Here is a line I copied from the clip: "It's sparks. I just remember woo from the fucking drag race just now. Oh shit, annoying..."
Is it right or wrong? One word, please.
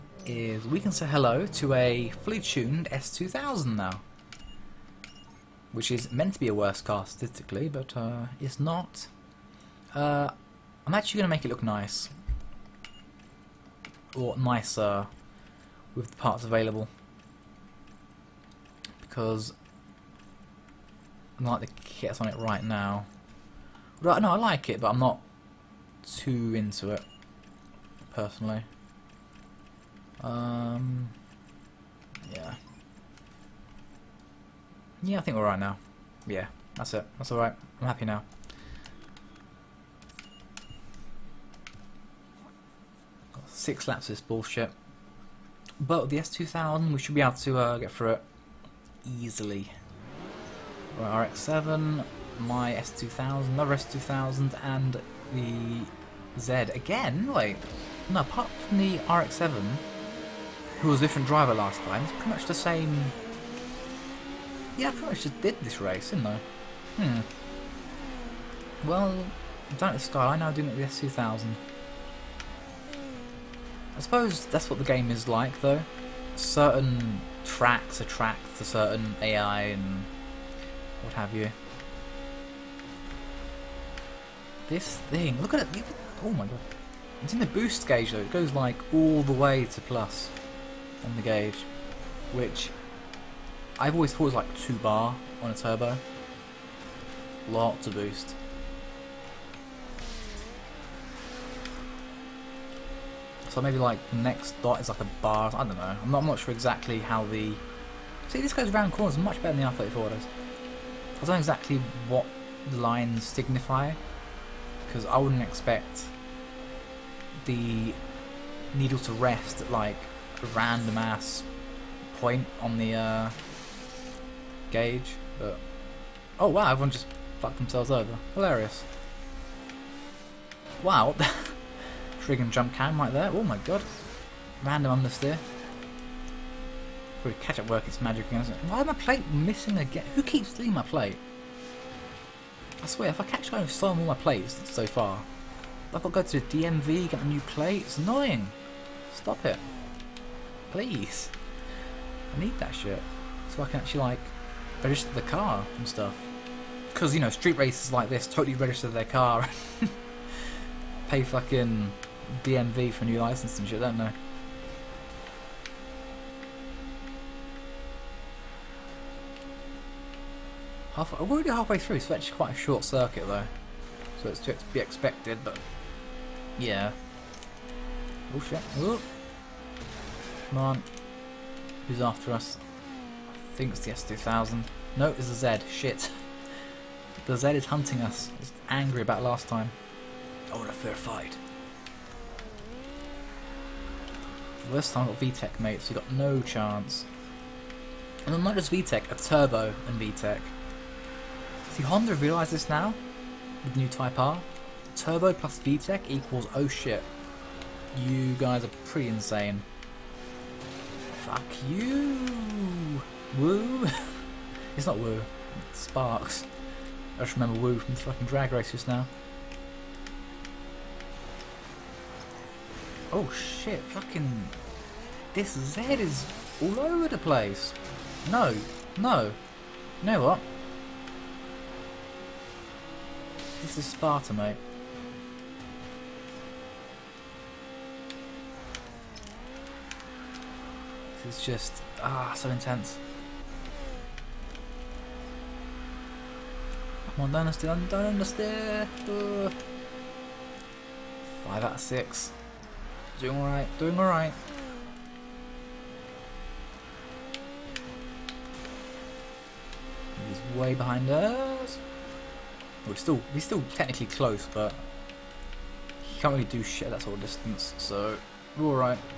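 wrong.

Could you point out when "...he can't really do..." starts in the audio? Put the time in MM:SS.
04:26.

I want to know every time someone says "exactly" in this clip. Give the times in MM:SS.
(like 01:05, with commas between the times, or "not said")
01:46, 01:51.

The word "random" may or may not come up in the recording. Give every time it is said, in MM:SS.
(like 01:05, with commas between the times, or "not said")
02:00, 02:14.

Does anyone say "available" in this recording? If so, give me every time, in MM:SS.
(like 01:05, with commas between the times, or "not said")
00:16.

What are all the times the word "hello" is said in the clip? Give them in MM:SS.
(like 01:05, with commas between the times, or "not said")
00:01.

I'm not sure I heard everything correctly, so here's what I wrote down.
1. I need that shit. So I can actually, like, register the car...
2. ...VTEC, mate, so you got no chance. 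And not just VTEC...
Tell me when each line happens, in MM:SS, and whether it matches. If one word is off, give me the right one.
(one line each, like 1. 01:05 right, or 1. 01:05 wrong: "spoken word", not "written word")
1. 02:32 right
2. 03:15 right.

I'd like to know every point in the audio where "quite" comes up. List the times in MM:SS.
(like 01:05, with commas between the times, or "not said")
02:52.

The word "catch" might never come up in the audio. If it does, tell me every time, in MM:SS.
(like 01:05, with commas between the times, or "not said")
02:17, 02:23.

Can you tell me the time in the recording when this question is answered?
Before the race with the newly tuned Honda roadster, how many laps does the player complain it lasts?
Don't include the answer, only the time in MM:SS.
00:43.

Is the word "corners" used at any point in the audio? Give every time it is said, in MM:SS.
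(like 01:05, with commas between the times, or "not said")
01:48.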